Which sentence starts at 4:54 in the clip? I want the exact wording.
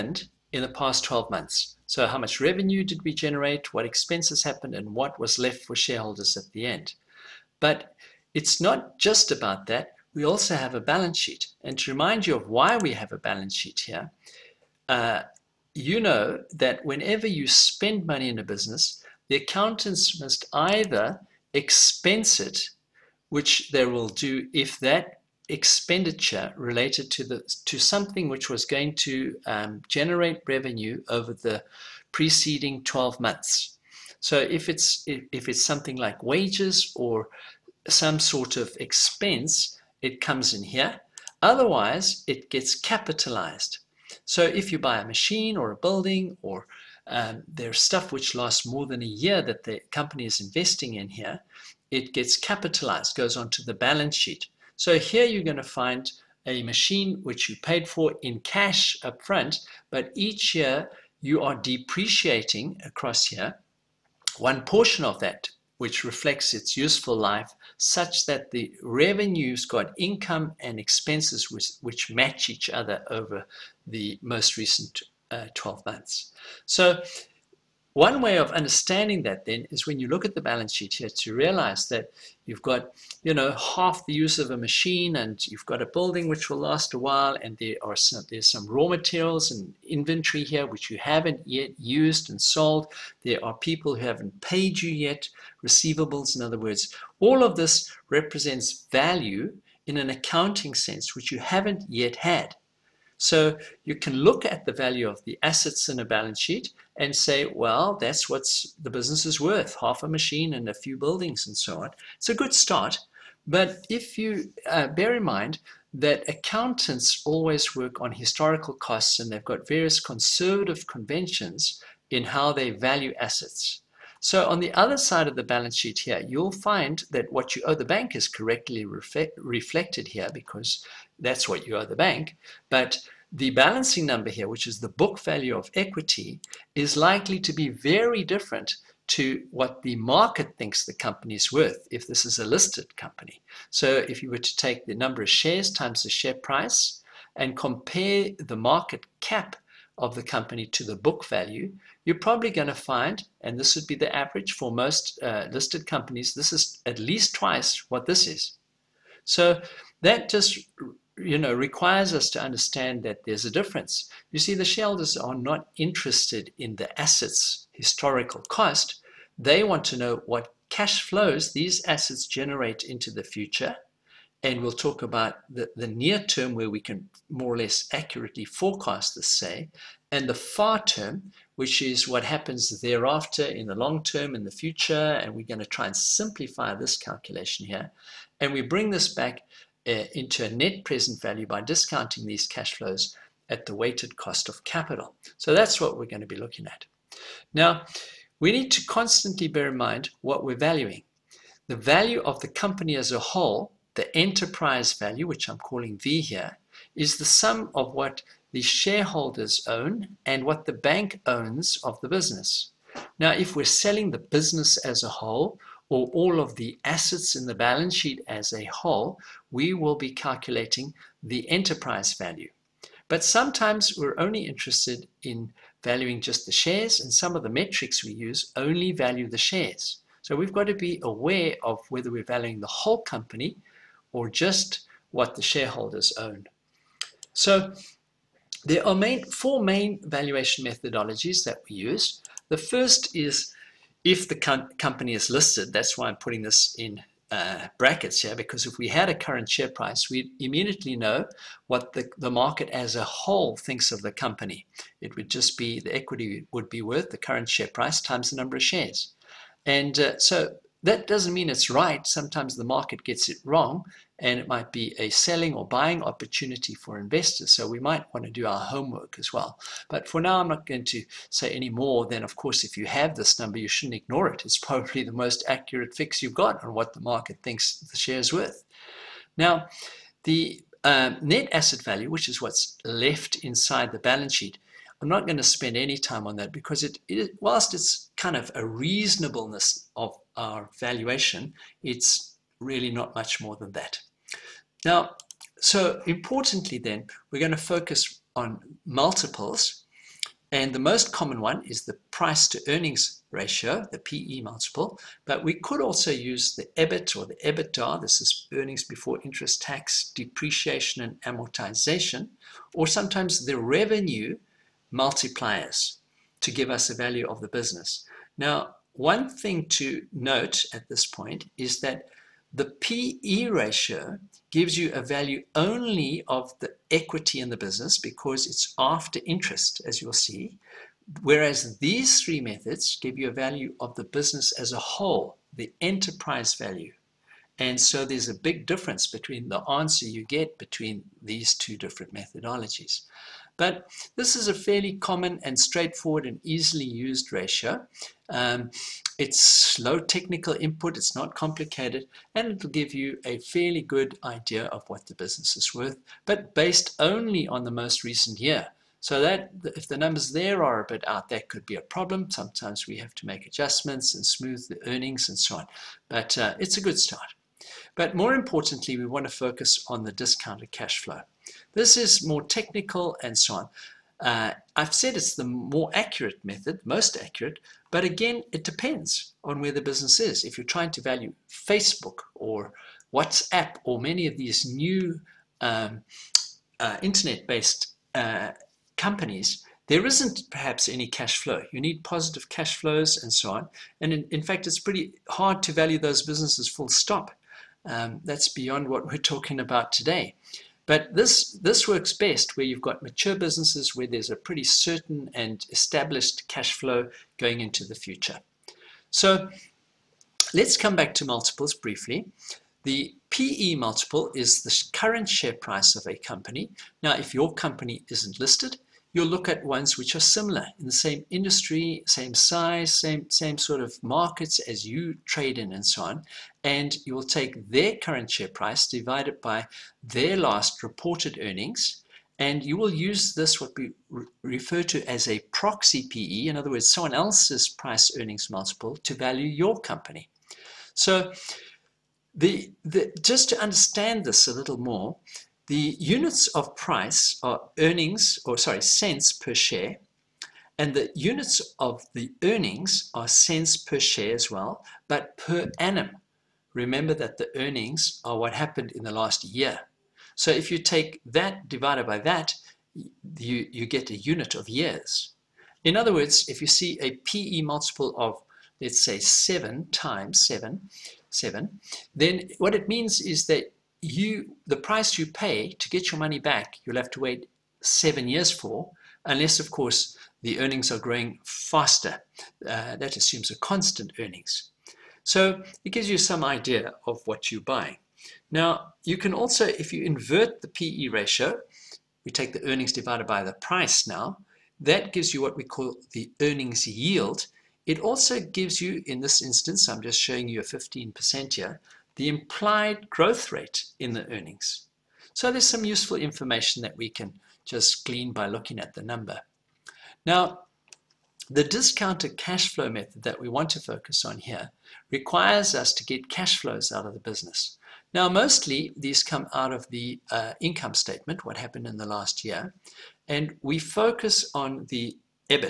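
Now, so importantly then, we're going to focus on multiples.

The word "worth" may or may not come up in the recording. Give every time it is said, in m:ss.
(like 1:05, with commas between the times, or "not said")
1:49, 2:21, 4:16, 4:38, 5:55.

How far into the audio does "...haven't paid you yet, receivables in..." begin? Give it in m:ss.
1:34.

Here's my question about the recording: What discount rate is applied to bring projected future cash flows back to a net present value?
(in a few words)
weighted cost of capital.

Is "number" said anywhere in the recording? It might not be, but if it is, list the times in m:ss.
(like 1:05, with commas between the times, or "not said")
2:14, 2:24, 4:18, 4:33, 5:59, 8:29.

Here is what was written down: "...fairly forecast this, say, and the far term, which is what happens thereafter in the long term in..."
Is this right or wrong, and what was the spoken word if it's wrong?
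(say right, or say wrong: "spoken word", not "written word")
wrong: "accurately", not "fairly".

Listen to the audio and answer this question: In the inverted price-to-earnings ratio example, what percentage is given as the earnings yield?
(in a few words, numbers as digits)
15%.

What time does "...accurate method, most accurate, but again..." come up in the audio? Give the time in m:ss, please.
6:15.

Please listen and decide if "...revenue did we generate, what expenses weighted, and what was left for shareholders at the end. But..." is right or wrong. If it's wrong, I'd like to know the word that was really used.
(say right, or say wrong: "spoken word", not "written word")
wrong: "happened", not "weighted".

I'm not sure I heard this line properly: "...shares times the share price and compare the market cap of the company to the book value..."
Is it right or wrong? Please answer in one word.
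right.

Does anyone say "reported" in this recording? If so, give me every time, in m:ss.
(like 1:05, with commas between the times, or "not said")
7:10.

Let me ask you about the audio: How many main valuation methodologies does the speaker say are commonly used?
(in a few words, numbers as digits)
four.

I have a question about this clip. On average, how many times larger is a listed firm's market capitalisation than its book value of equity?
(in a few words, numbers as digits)
twice.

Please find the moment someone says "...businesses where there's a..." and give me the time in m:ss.
6:43.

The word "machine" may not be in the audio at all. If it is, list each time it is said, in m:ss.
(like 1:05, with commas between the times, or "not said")
0:45, 0:56, 1:24, 1:50.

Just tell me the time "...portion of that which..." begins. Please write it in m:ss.
1:04.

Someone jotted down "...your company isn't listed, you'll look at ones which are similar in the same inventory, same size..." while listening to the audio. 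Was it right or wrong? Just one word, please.
wrong.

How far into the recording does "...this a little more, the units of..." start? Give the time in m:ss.
7:24.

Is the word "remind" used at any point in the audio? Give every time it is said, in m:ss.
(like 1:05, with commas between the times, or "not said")
0:11.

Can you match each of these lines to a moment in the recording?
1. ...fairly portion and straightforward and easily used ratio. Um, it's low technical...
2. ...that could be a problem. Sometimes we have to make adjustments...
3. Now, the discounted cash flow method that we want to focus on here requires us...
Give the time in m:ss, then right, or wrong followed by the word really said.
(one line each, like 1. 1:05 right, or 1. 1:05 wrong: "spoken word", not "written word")
1. 5:44 wrong: "common", not "portion"
2. 6:01 right
3. 8:30 right.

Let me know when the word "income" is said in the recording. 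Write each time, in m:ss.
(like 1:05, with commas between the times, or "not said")
1:09, 8:40.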